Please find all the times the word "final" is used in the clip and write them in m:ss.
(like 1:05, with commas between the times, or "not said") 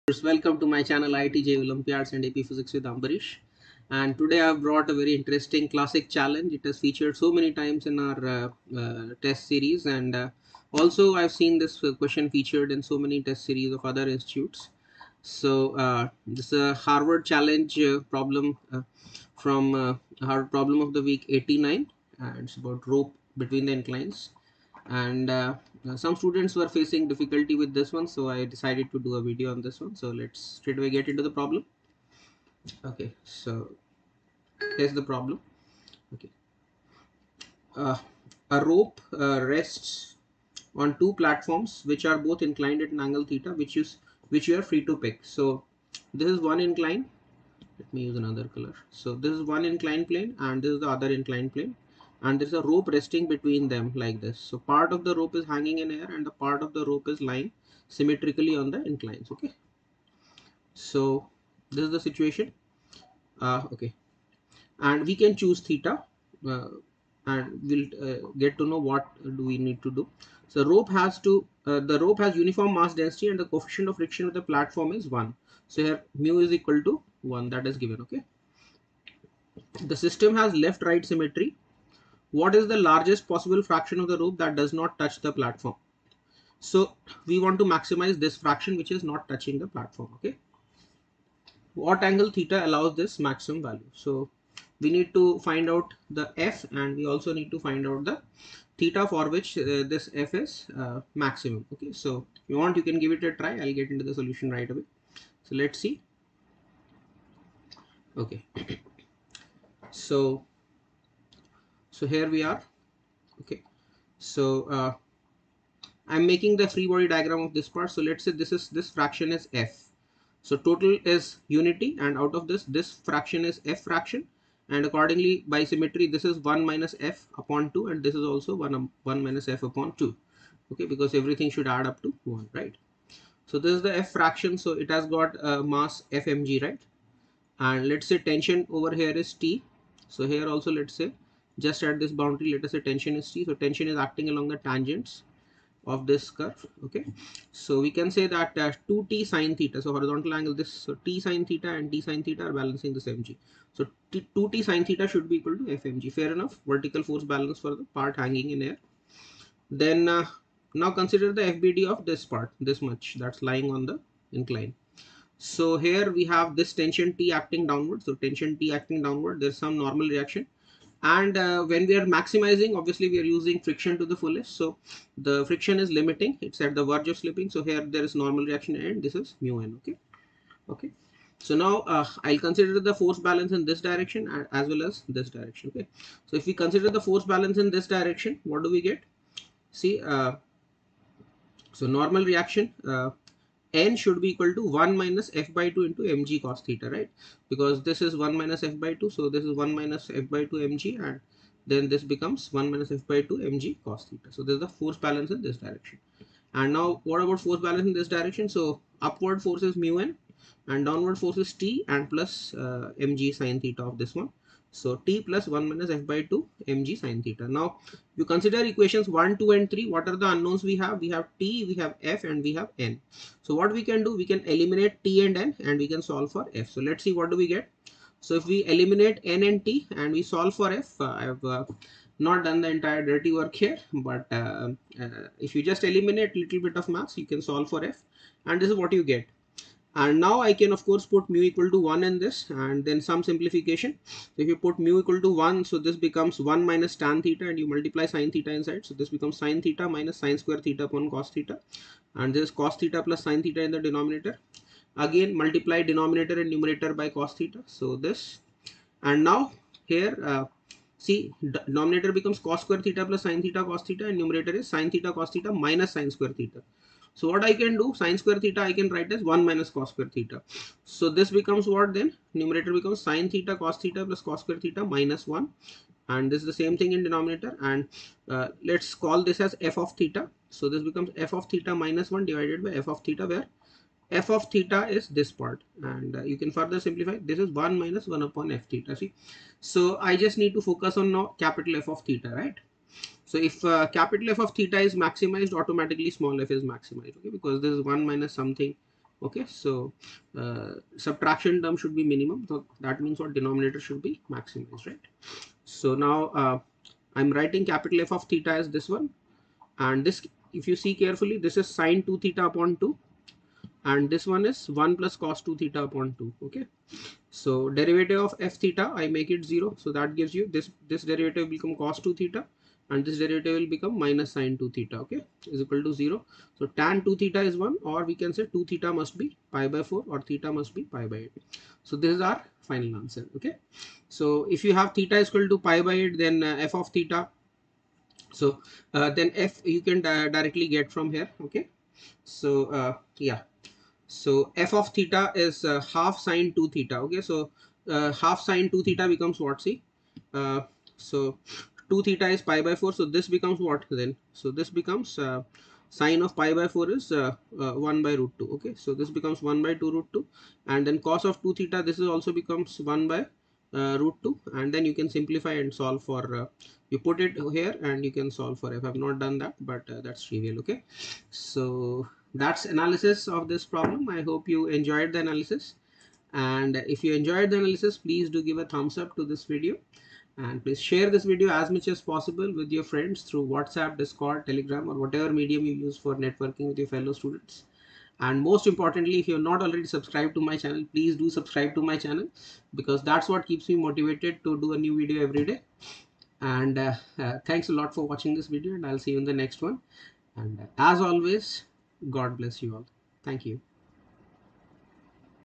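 5:32.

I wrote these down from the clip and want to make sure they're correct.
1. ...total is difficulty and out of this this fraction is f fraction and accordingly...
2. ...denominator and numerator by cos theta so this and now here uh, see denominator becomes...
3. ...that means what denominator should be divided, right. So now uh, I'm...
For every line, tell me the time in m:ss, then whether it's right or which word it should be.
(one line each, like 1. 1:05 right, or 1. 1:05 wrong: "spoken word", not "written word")
1. 2:00 wrong: "unity", not "difficulty"
2. 4:15 right
3. 5:02 wrong: "maximized", not "divided".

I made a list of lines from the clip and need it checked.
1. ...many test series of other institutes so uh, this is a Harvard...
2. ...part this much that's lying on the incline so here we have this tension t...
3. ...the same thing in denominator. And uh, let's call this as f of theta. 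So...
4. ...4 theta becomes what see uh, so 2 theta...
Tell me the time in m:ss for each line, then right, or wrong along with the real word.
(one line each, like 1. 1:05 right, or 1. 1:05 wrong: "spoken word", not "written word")
1. 0:12 right
2. 2:42 right
3. 4:36 right
4. 5:48 wrong: "2", not "4".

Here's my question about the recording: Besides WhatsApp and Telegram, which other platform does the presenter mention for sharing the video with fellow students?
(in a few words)
Discord.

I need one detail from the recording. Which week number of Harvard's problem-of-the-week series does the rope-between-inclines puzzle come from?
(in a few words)
89.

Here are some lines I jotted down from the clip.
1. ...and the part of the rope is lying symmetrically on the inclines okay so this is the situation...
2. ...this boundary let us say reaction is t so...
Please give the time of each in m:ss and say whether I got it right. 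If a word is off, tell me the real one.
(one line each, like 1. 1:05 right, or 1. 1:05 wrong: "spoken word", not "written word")
1. 0:56 right
2. 2:21 wrong: "tension", not "reaction".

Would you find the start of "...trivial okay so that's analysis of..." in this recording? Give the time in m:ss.
6:10.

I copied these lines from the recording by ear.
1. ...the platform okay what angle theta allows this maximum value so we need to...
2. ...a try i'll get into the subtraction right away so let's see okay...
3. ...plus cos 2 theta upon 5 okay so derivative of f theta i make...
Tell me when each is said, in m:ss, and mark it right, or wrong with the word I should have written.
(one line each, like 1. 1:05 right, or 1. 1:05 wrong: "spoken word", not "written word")
1. 1:29 right
2. 1:43 wrong: "solution", not "subtraction"
3. 5:14 wrong: "2", not "5".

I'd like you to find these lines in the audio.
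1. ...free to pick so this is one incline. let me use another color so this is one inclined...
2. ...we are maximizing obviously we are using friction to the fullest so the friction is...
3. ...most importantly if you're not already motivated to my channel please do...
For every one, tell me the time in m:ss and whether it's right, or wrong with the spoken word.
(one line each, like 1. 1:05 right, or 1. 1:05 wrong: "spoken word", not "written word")
1. 0:44 right
2. 2:51 right
3. 6:28 wrong: "subscribed", not "motivated".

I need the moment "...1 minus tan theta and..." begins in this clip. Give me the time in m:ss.
4:06.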